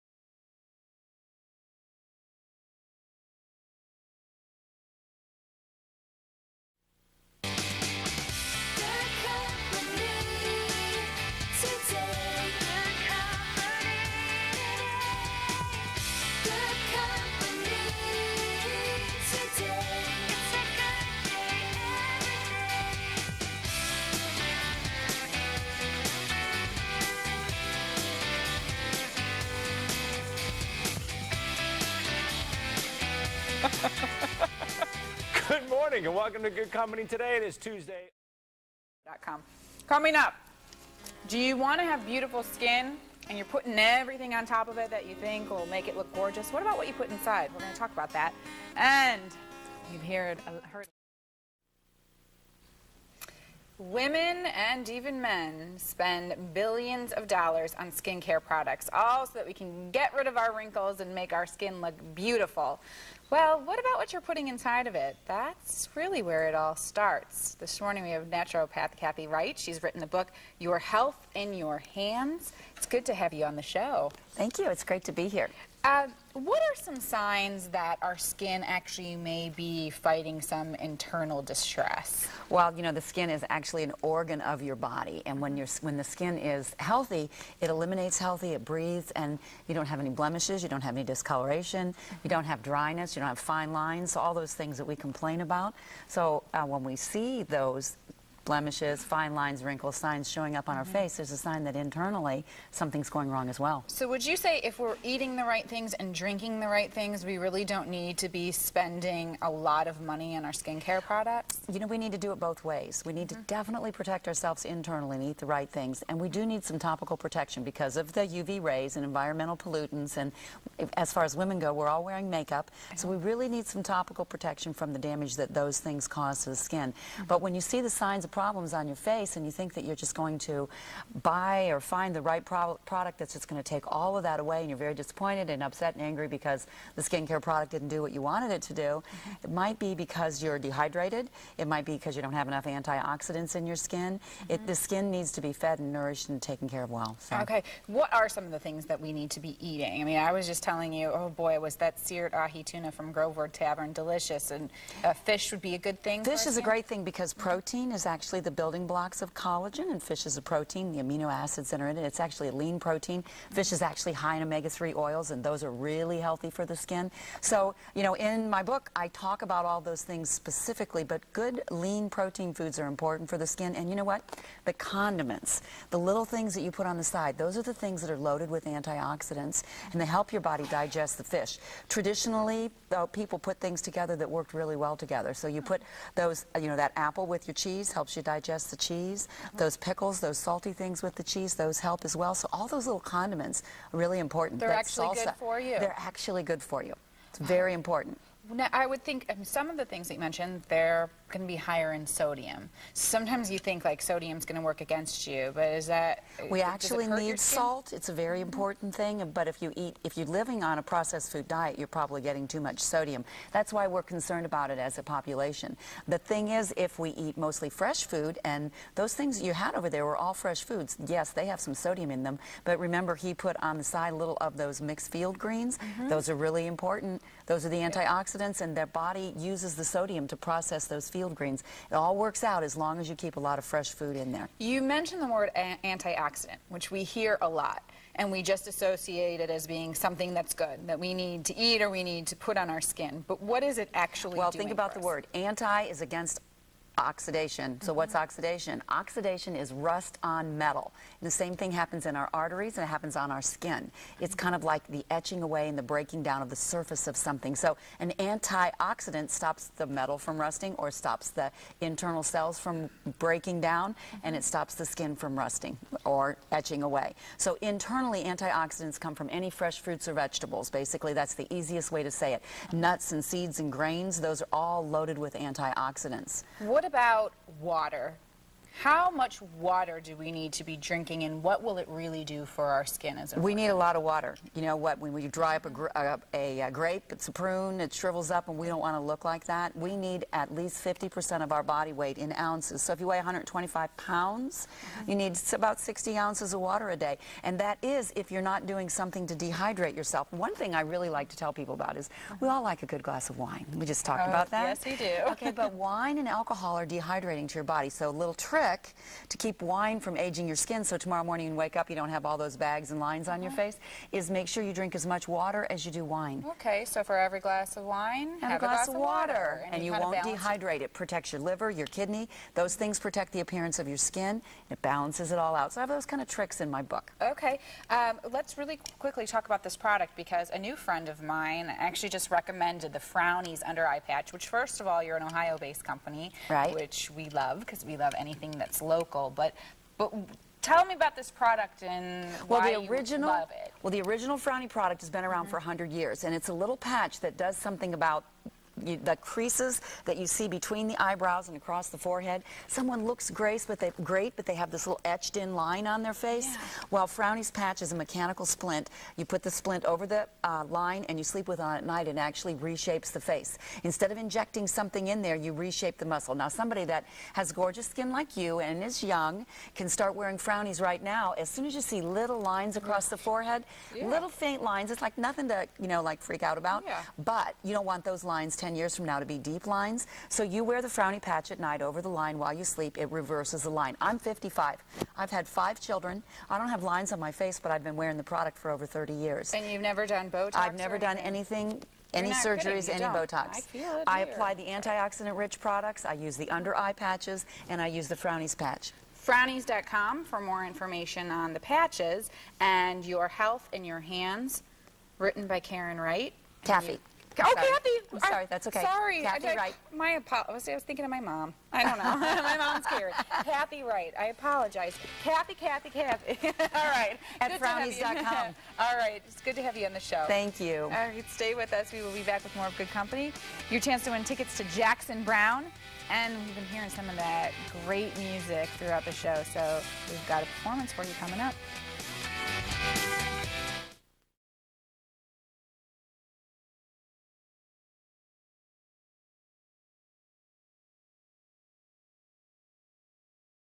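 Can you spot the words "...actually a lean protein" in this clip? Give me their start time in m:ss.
2:42.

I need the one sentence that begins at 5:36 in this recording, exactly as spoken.
which we love because we love anything something that's local.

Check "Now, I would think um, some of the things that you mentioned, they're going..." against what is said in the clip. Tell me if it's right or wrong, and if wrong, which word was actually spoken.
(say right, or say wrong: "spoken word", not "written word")
right.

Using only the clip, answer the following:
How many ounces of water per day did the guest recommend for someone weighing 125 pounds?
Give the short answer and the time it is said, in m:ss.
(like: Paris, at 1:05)
60, at 4:55.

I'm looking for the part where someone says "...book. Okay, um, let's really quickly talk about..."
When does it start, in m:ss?
5:26.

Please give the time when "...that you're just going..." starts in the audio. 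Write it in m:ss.
2:09.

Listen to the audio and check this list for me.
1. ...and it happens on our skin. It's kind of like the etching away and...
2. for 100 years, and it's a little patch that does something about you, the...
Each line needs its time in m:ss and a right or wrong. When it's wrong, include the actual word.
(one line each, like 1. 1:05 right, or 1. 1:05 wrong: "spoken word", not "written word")
1. 4:12 right
2. 5:45 right.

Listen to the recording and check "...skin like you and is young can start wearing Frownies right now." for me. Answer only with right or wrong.
right.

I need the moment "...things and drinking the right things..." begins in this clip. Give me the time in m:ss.
1:45.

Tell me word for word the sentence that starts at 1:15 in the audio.
Uh, what are some signs that our skin actually may be fighting some internal distress?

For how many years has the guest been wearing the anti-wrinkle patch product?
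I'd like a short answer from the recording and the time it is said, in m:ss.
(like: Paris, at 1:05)
30, at 6:28.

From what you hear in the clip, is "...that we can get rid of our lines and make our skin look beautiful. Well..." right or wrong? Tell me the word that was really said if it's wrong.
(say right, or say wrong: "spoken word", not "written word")
wrong: "wrinkles", not "lines".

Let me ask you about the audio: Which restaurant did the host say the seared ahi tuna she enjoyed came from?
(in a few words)
Grover Tavern.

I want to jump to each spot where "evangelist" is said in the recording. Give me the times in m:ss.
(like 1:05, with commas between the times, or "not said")
not said.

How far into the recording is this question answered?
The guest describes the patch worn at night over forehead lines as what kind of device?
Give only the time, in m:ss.
5:57.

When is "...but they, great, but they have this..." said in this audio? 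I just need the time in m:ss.
5:53.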